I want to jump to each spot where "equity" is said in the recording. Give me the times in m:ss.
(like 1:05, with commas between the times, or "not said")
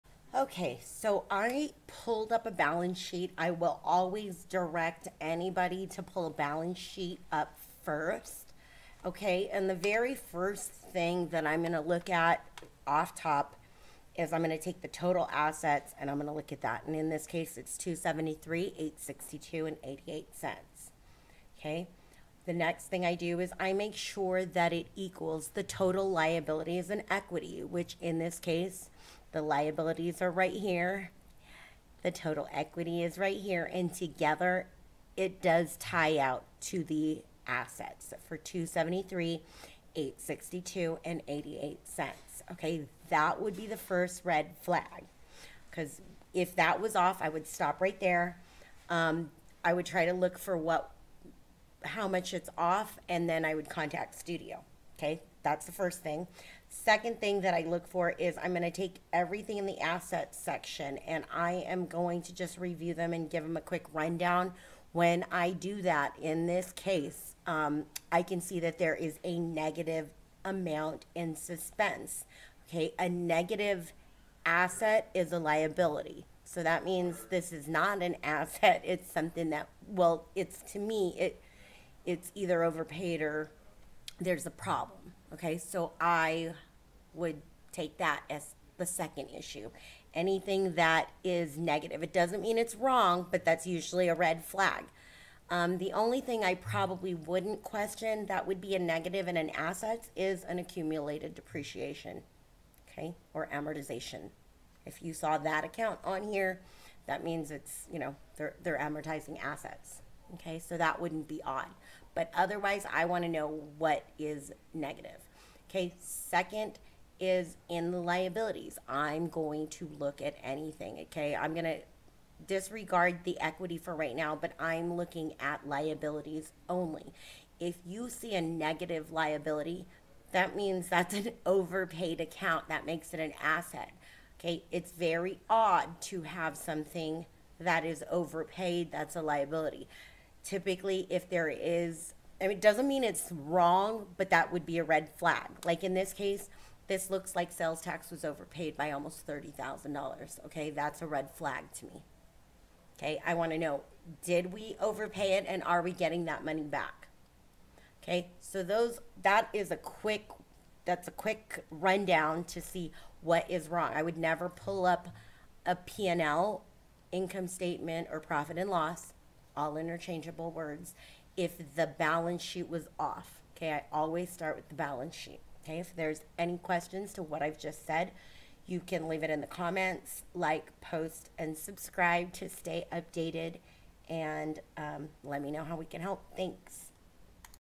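0:27, 0:32, 2:03.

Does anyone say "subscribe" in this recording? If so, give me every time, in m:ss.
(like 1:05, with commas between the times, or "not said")
3:01.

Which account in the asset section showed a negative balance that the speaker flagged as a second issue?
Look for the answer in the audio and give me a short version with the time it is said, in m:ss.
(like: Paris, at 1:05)
Suspense, at 1:11.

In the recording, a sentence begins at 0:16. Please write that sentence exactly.
And in this case, it's 273, 862 and 88 cents.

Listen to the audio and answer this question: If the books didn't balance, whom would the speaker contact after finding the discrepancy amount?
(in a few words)
Studio.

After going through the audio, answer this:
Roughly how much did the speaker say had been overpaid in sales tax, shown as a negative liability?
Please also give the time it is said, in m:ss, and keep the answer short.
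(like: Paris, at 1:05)
$30,000, at 2:29.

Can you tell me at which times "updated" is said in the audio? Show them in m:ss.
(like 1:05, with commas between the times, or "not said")
3:02.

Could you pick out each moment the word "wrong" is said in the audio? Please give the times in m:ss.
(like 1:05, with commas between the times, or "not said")
1:32, 2:23, 2:43.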